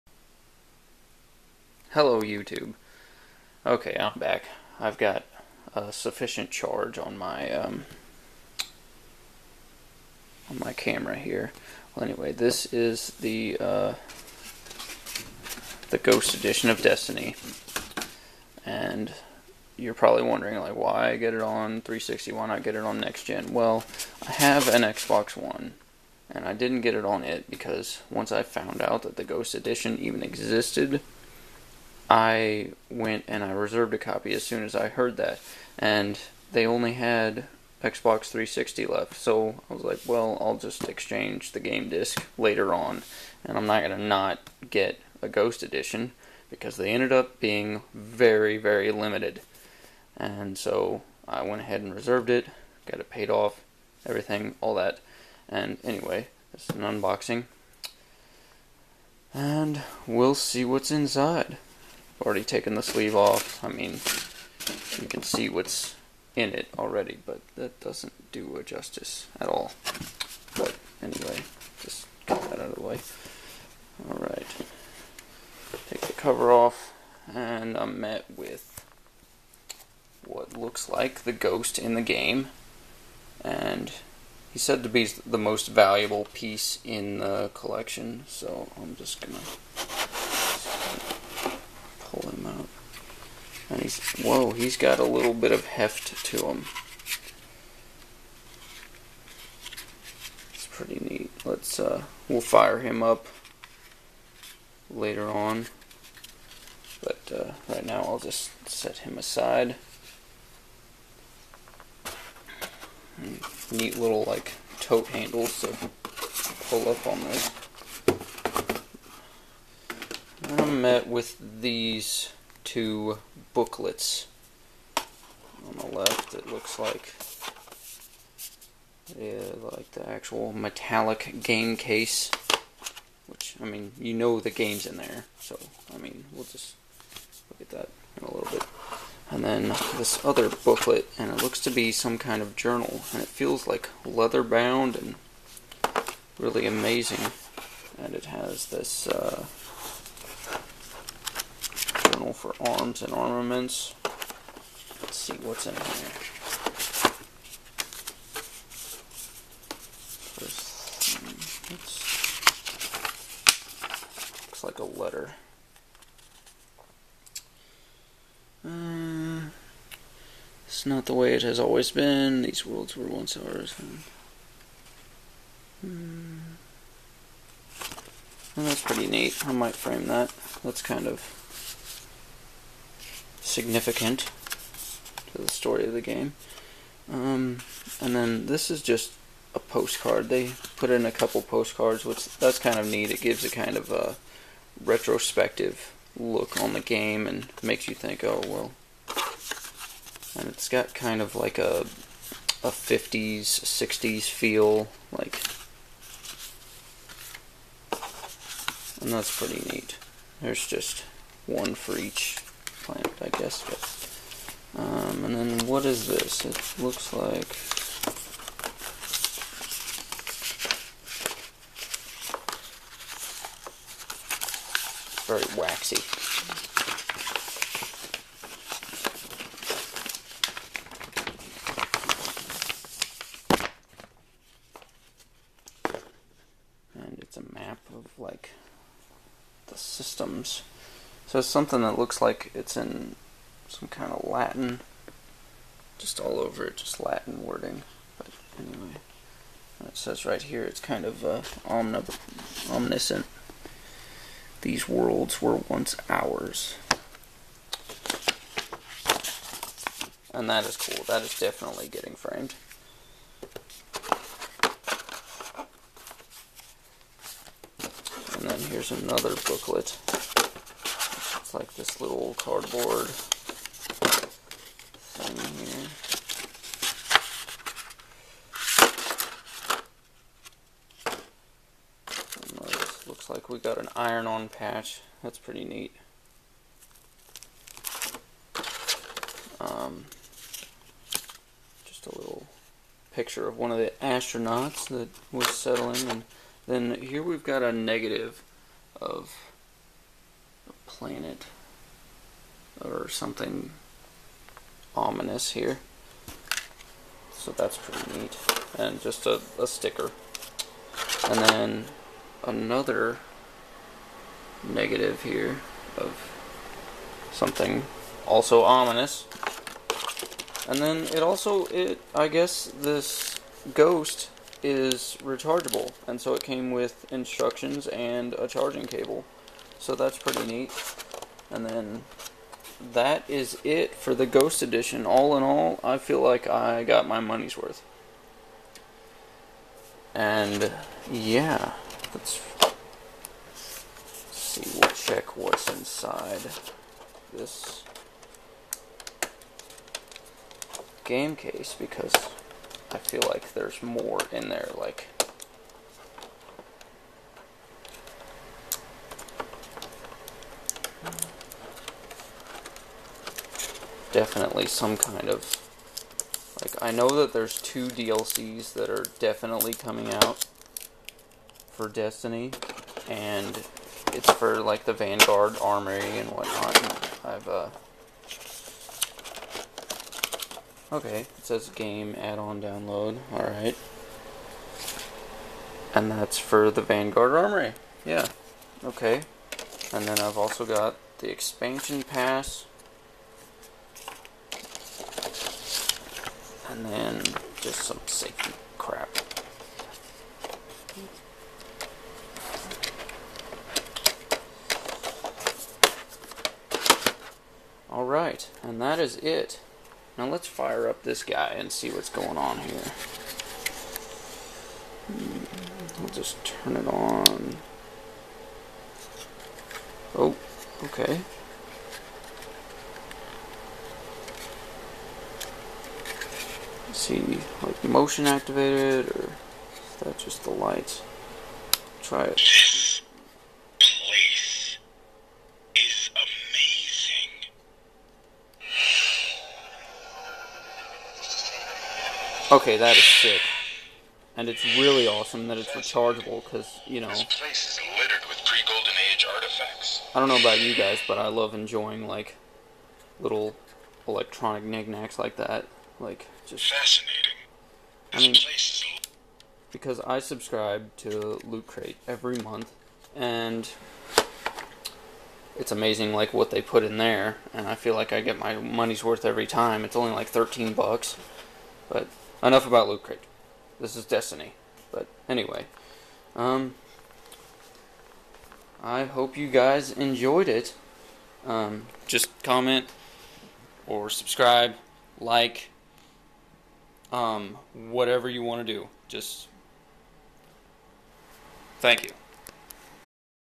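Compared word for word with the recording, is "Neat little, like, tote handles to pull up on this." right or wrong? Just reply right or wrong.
right.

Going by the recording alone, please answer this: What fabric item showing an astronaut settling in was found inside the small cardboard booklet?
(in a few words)
iron-on patch.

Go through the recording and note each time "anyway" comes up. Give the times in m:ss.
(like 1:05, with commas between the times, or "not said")
0:12, 0:55, 1:11, 4:08, 7:55.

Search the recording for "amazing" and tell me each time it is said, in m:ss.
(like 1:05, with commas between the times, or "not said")
2:26, 7:45.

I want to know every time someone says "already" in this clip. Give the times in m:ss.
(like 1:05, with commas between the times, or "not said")
1:02, 1:06.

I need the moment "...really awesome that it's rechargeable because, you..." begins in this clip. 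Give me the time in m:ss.
7:24.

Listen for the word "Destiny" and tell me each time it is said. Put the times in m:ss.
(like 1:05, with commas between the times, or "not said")
0:16, 6:11, 7:54.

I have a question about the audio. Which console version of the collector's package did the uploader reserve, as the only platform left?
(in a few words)
Xbox 360.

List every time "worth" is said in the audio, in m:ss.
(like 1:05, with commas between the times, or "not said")
5:37, 7:49.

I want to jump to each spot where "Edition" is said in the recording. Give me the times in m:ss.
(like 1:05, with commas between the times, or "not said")
0:16, 0:29, 0:45, 5:34.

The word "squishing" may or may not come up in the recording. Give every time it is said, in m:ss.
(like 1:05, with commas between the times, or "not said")
not said.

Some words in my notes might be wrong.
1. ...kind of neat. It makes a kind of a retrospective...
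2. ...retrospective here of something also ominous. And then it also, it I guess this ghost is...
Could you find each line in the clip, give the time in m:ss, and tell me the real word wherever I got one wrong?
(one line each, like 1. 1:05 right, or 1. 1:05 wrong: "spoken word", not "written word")
1. 3:12 wrong: "gives", not "makes"
2. 5:14 wrong: "negative", not "retrospective".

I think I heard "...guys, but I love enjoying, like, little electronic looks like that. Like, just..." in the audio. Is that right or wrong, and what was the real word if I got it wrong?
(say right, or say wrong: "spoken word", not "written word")
wrong: "knickknacks", not "looks".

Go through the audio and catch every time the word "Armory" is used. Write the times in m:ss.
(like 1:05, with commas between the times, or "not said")
6:15, 6:27.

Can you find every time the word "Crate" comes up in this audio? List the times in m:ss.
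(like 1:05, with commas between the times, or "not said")
7:41, 7:53.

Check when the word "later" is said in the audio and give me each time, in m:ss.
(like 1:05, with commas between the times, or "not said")
0:42, 1:44.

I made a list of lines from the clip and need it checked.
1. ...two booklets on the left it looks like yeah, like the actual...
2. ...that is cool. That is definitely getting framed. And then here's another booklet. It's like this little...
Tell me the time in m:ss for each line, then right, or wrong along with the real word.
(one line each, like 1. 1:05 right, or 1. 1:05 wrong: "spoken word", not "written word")
1. 2:02 right
2. 4:20 right.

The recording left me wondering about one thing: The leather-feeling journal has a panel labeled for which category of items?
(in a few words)
arms and armaments.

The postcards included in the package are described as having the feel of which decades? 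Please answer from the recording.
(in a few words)
50s, 60s.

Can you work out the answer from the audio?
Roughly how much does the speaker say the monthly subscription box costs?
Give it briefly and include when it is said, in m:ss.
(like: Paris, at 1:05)
13 bucks, at 7:50.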